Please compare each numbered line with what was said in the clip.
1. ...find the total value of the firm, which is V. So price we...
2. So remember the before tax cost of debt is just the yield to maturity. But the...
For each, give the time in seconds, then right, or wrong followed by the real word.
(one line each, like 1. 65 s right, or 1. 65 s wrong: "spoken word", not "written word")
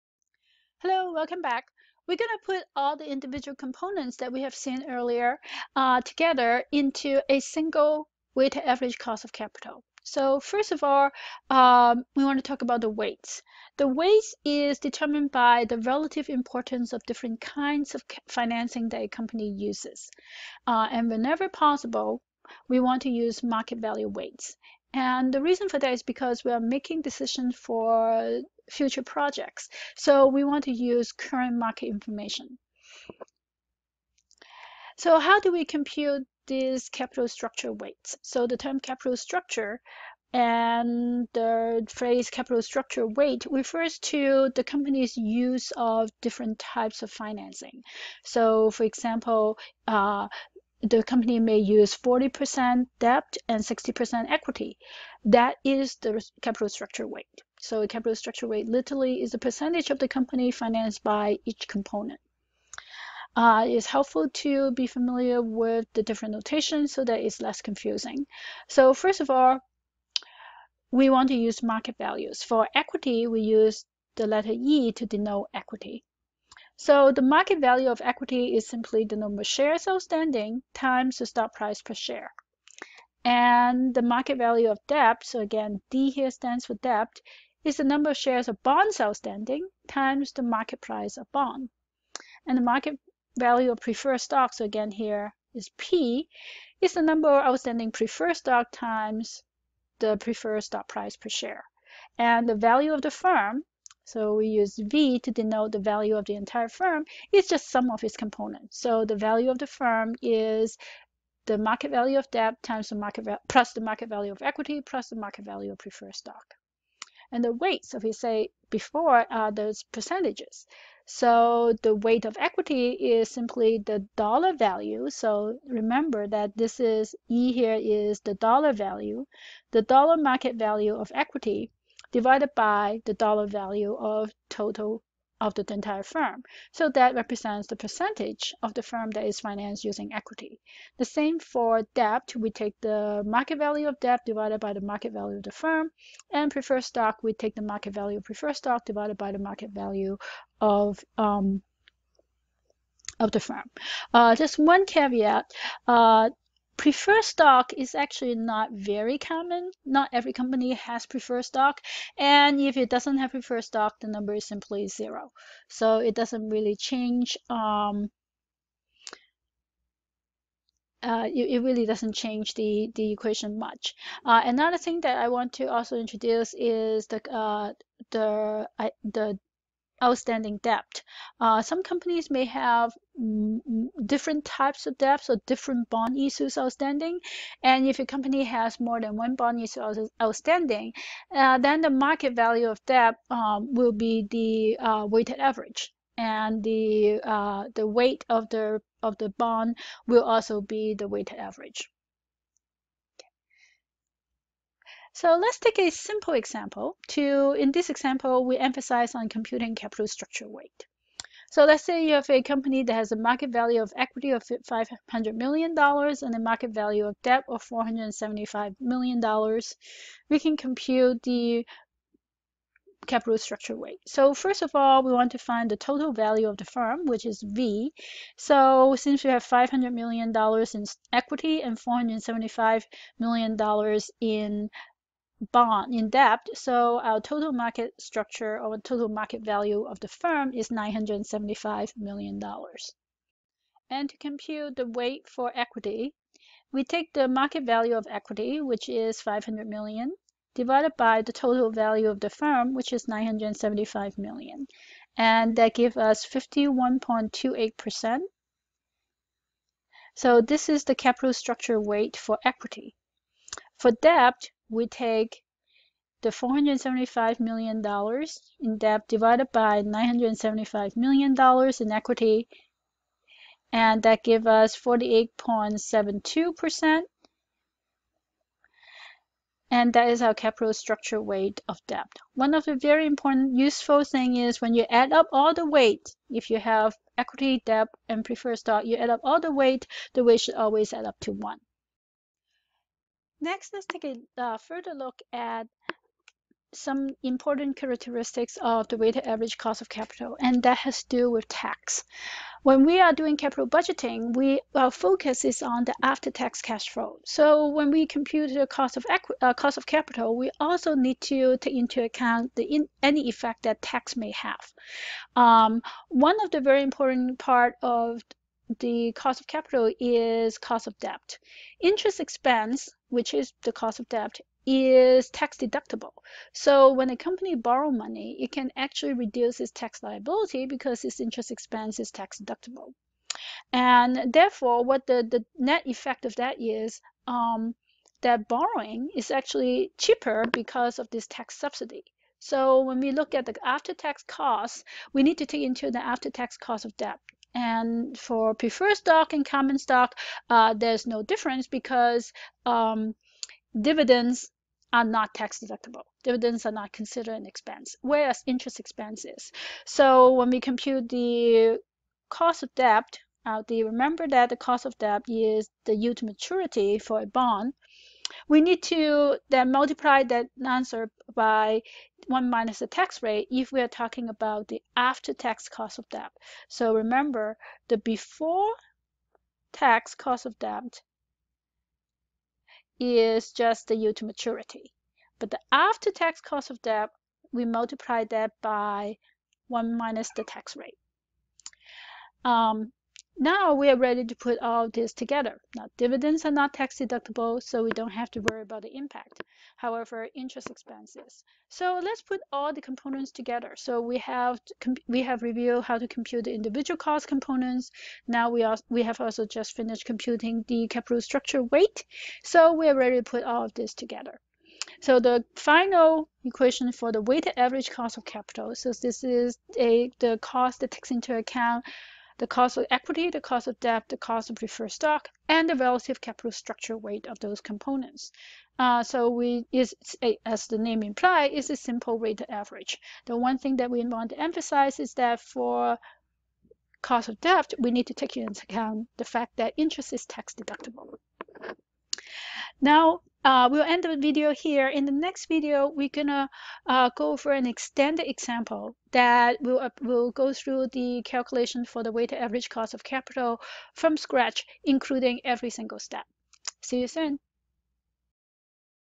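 1. 225 s wrong: "since", not "price"
2. 376 s right.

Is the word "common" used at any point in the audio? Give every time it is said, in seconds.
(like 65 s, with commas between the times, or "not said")
159 s, 349 s.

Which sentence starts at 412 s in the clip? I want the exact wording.
So we are ready to put all of this together.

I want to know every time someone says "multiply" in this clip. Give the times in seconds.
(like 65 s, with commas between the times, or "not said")
369 s, 387 s.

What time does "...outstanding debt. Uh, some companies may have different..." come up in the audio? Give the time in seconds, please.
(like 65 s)
180 s.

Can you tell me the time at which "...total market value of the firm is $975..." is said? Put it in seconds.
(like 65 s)
238 s.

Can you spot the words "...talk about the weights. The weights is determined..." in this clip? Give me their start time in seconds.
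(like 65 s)
12 s.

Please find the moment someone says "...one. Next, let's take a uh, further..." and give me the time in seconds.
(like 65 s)
291 s.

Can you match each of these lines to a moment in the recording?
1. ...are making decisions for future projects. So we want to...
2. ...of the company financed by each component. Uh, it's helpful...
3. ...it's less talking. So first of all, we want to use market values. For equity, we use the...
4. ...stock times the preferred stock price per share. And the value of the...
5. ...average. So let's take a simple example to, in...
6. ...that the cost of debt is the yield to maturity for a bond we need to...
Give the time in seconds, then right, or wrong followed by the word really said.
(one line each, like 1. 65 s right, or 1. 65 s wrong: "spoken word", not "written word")
1. 26 s right
2. 59 s right
3. 67 s wrong: "confusing", not "talking"
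4. 98 s right
5. 201 s right
6. 364 s right.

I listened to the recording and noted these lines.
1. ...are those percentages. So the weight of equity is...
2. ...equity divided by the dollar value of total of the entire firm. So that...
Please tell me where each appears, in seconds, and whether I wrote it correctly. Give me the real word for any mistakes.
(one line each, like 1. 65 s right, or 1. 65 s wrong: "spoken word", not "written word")
1. 119 s right
2. 131 s right.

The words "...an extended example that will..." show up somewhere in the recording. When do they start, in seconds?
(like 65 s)
447 s.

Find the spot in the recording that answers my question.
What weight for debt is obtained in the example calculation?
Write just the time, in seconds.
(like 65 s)
274 s.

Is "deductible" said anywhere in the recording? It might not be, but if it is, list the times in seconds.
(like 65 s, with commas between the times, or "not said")
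325 s, 332 s, 355 s, 396 s, 440 s.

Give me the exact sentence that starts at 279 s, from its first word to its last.
And that is our capital structure weight of debt.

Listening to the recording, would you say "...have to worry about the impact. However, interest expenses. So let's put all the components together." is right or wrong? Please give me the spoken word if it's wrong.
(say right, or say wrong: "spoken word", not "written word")
right.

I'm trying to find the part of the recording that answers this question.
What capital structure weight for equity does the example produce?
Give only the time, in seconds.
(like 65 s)
256 s.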